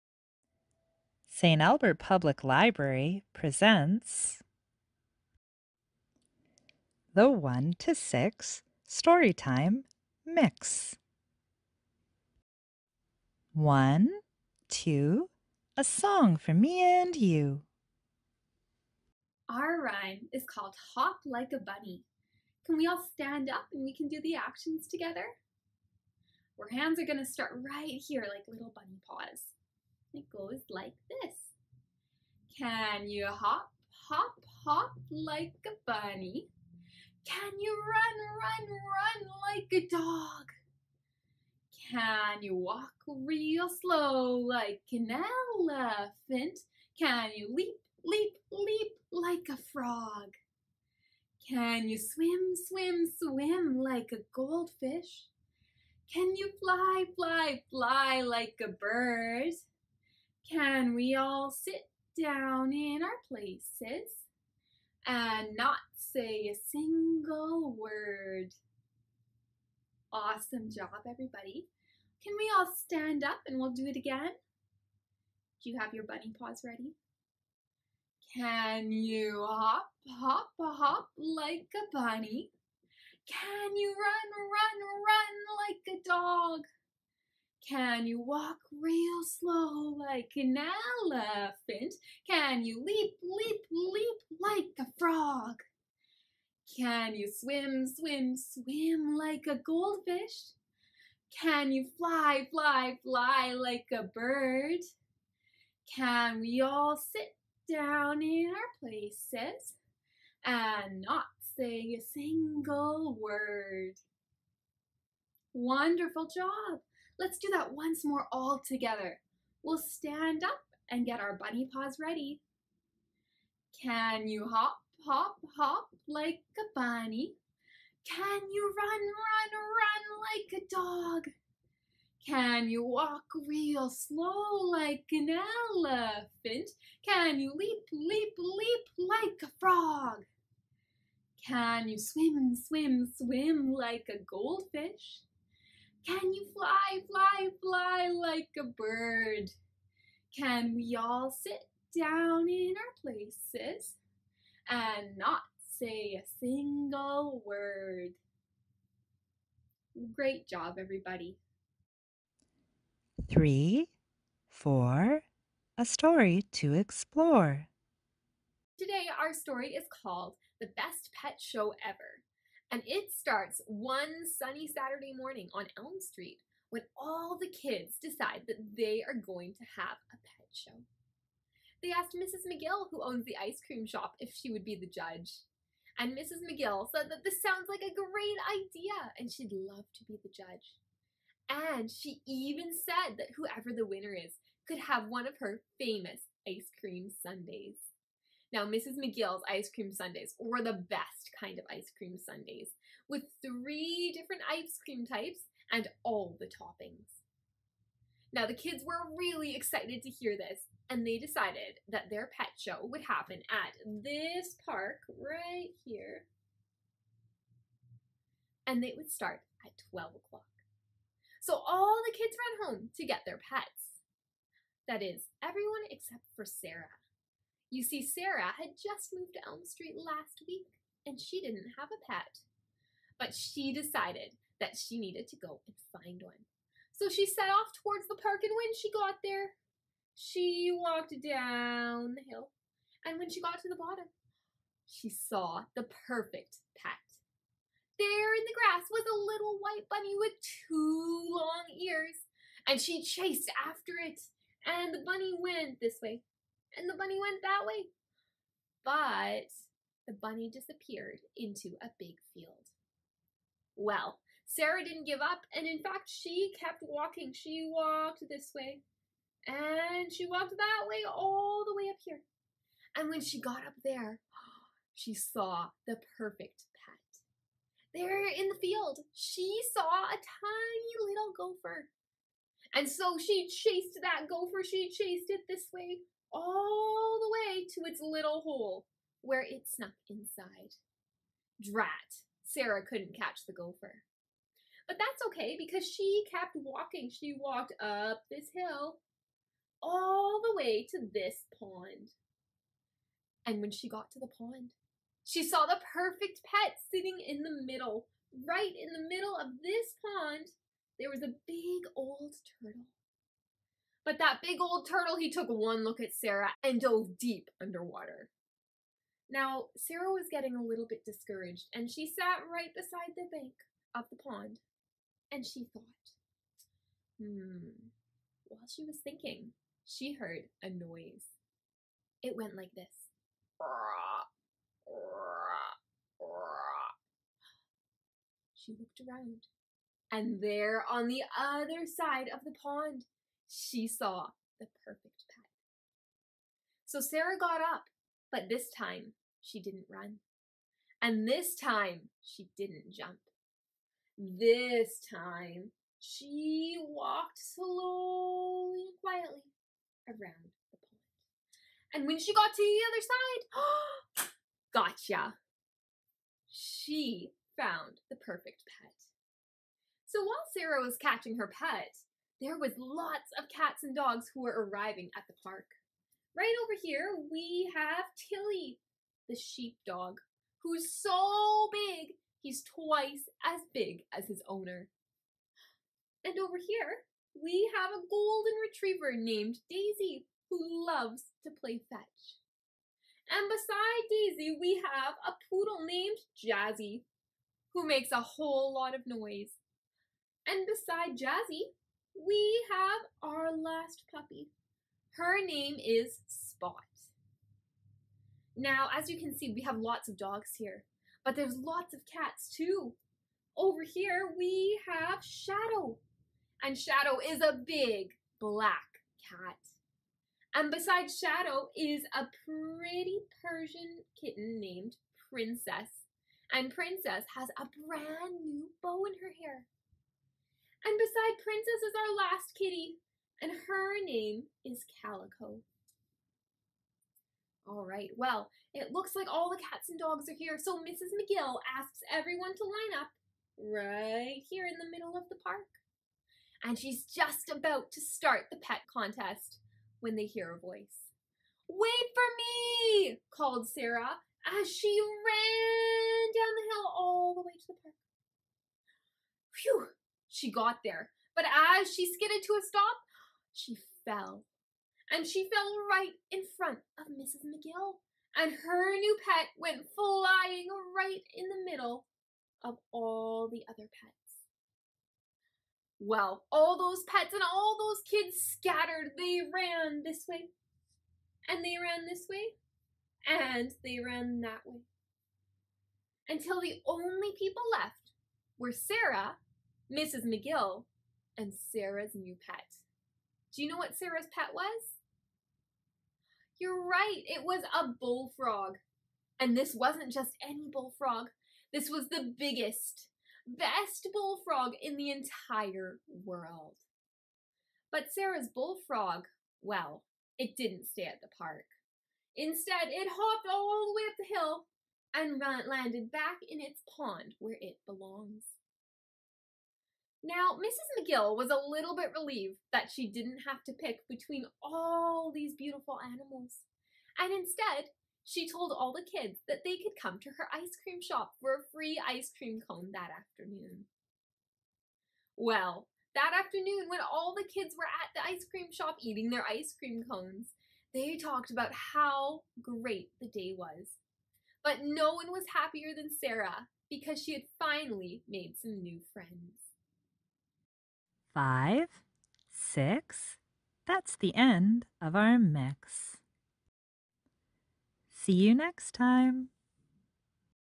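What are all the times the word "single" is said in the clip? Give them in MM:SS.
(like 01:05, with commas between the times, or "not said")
01:06, 01:52, 02:36.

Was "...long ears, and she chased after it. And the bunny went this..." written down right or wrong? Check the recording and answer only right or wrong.
right.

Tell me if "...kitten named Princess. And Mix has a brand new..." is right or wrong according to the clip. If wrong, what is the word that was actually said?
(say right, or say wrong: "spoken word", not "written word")
wrong: "Princess", not "Mix".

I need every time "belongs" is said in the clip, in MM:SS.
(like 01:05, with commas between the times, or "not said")
08:37.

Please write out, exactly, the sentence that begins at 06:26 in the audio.
And over here, we have a golden retriever named Daisy, who loves to play fetch.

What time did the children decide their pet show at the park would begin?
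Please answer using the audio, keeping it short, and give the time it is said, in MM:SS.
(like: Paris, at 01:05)
12 o'clock, at 03:39.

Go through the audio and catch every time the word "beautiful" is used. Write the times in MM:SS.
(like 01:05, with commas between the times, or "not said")
08:45.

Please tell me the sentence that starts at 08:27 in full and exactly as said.
But Sarah's bullfrog, well, it didn't stay at the park.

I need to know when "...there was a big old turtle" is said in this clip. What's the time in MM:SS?
05:10.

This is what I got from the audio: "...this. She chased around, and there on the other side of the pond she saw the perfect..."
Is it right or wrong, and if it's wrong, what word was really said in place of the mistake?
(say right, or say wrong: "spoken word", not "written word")
wrong: "looked", not "chased".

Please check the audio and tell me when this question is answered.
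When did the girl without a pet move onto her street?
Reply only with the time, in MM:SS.
03:49.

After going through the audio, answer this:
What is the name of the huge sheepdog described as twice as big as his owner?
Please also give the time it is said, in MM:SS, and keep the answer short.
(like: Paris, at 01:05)
Tilly, at 06:18.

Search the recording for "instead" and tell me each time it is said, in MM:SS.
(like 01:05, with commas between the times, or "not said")
08:32, 08:47.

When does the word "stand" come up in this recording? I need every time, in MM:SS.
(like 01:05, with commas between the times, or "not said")
00:23, 01:12, 01:59.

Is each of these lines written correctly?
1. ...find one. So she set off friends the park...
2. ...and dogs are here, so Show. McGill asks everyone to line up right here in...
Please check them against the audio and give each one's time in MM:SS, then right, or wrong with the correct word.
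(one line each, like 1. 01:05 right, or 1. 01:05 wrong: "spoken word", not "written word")
1. 03:56 wrong: "towards", not "friends"
2. 07:19 wrong: "Mrs", not "Show".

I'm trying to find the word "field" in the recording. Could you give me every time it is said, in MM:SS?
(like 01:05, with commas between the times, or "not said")
04:22, 04:38.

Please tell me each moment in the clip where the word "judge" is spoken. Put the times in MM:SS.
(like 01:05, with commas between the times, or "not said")
03:04, 03:10.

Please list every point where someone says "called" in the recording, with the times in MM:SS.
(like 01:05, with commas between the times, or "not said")
00:20, 02:50, 07:33.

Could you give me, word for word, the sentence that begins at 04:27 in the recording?
She walked this way, and she walked that way all the way up here.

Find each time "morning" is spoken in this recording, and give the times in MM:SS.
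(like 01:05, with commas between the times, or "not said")
02:55.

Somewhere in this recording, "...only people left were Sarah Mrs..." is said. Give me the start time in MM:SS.
08:06.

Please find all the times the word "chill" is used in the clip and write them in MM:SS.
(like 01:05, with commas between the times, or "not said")
not said.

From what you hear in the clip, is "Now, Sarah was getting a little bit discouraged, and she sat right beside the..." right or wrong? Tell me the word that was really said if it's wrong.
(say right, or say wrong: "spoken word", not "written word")
right.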